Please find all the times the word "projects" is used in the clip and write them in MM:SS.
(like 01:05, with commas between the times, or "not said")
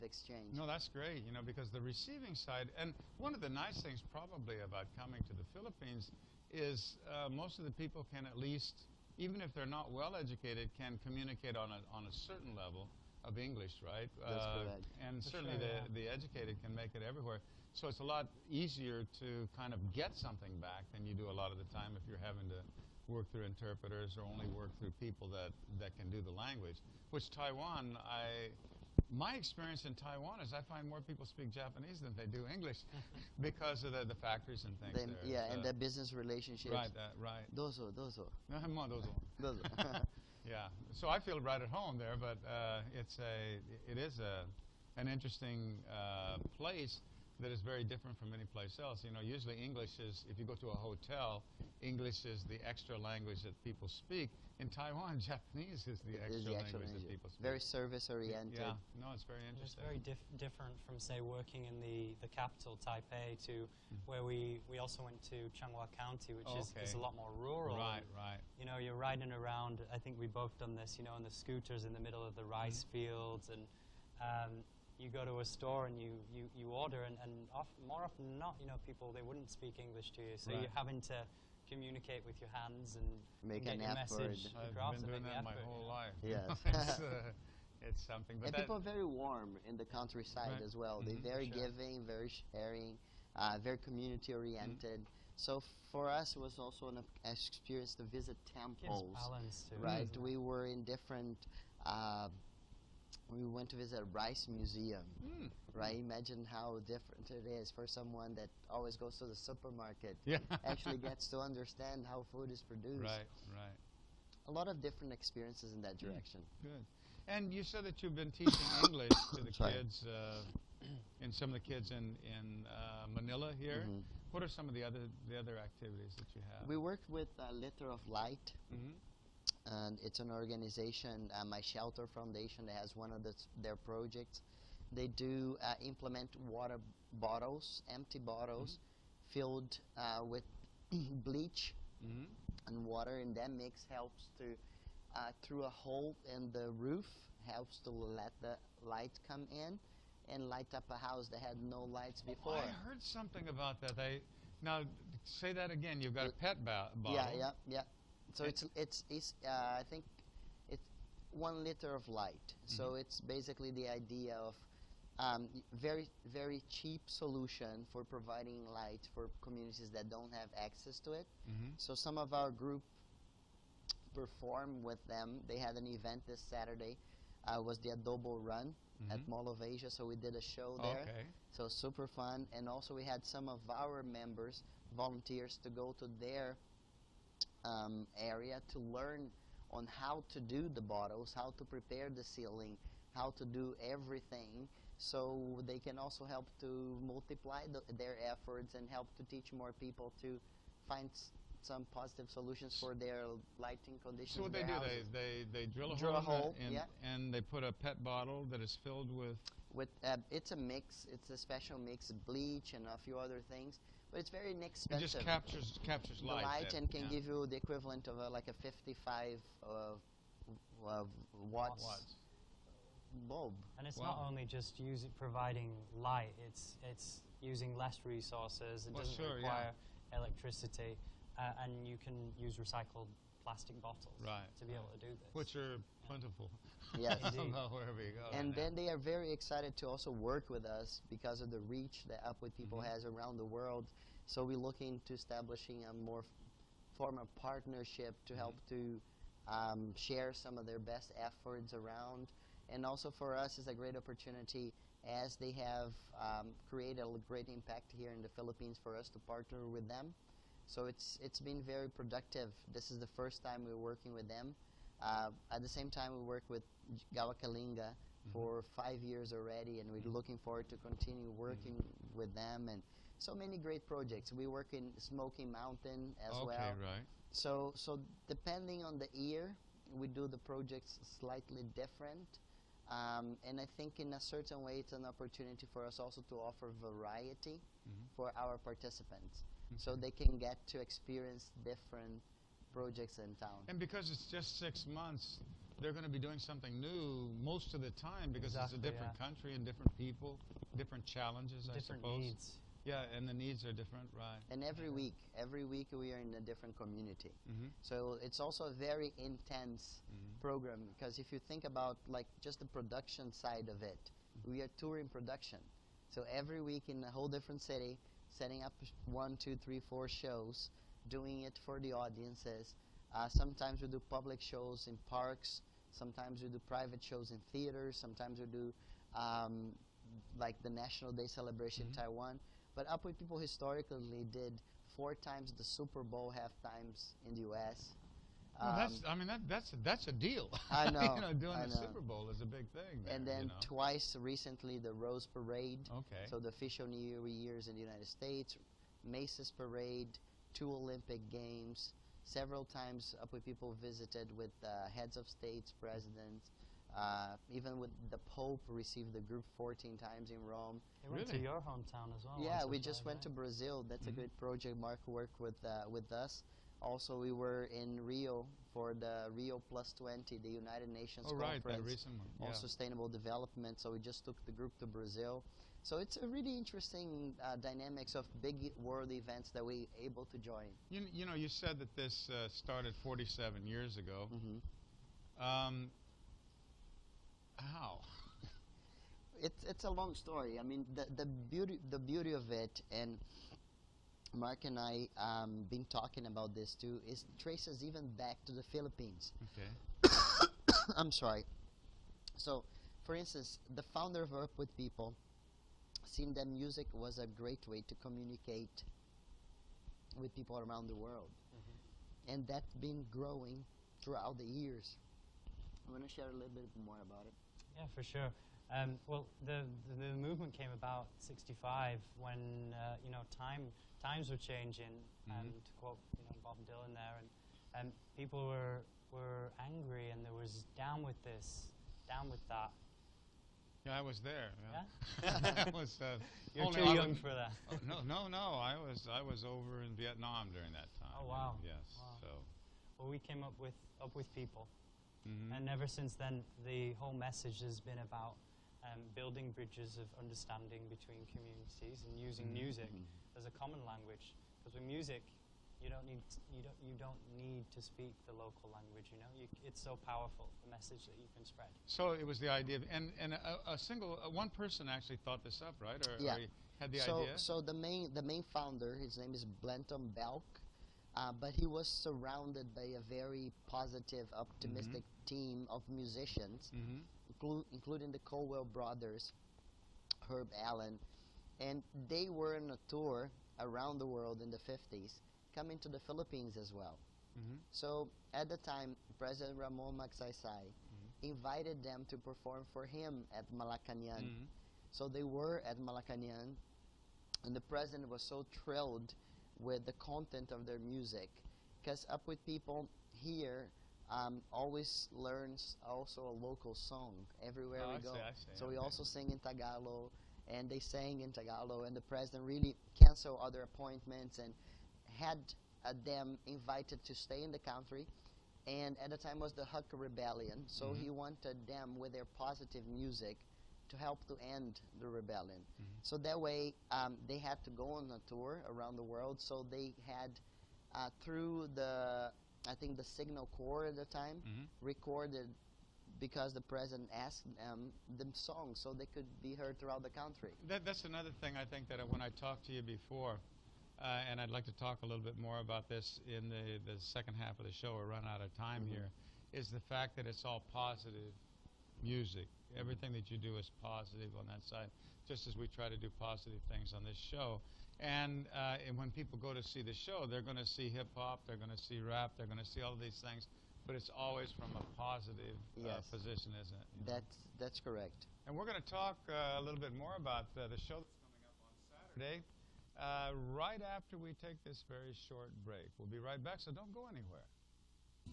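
02:13, 04:33, 04:40, 04:52, 06:04.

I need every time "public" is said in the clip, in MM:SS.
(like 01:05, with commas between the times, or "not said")
05:24.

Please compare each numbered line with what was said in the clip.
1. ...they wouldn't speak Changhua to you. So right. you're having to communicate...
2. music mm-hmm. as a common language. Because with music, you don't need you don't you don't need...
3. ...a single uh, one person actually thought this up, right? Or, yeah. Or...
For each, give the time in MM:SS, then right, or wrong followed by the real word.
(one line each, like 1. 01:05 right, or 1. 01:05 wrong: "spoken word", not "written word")
1. 01:19 wrong: "English", not "Changhua"
2. 07:32 right
3. 07:43 right.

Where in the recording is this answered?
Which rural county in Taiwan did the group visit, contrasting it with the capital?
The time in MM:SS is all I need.
01:05.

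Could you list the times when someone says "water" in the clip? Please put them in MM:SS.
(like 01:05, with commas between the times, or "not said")
02:16, 02:22.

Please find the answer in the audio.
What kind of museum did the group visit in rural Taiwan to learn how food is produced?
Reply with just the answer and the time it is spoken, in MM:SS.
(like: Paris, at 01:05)
Rice Museum, at 01:44.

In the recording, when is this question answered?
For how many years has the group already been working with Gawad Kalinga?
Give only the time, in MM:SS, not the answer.
04:28.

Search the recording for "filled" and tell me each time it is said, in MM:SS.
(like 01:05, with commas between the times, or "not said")
02:19, 03:28.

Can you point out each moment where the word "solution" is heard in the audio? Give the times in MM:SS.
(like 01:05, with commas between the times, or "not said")
02:47, 03:22.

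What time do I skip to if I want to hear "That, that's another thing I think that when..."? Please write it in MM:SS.
09:00.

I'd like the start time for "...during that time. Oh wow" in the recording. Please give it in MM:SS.
07:20.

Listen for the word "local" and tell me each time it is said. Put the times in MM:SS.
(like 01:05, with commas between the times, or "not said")
07:38, 08:26.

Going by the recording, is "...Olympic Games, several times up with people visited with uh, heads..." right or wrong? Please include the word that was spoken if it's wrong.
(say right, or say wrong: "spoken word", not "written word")
right.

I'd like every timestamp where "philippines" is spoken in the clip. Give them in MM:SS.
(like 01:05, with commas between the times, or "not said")
00:05, 04:18, 06:38, 08:06.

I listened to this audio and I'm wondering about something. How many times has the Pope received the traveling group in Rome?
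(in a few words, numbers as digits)
14.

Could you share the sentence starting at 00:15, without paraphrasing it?
And For certainly sure, the, yeah.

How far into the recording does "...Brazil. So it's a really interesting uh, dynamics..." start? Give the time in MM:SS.
06:14.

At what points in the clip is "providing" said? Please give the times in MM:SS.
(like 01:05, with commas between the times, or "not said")
02:48, 03:45.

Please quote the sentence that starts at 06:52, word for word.
and that's been growing throughout the years.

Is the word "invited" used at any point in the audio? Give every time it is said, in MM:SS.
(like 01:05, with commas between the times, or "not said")
08:11, 08:36.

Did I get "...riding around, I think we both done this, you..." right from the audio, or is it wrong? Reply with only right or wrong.
right.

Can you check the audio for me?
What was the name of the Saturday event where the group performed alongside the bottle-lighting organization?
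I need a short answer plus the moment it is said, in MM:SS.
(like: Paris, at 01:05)
Adobo Run, at 02:57.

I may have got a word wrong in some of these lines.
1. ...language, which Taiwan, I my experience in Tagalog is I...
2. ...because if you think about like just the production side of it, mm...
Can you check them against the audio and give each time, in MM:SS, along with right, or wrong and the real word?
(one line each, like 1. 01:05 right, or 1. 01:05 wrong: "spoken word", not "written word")
1. 00:26 wrong: "Taiwan", not "Tagalog"
2. 05:10 right.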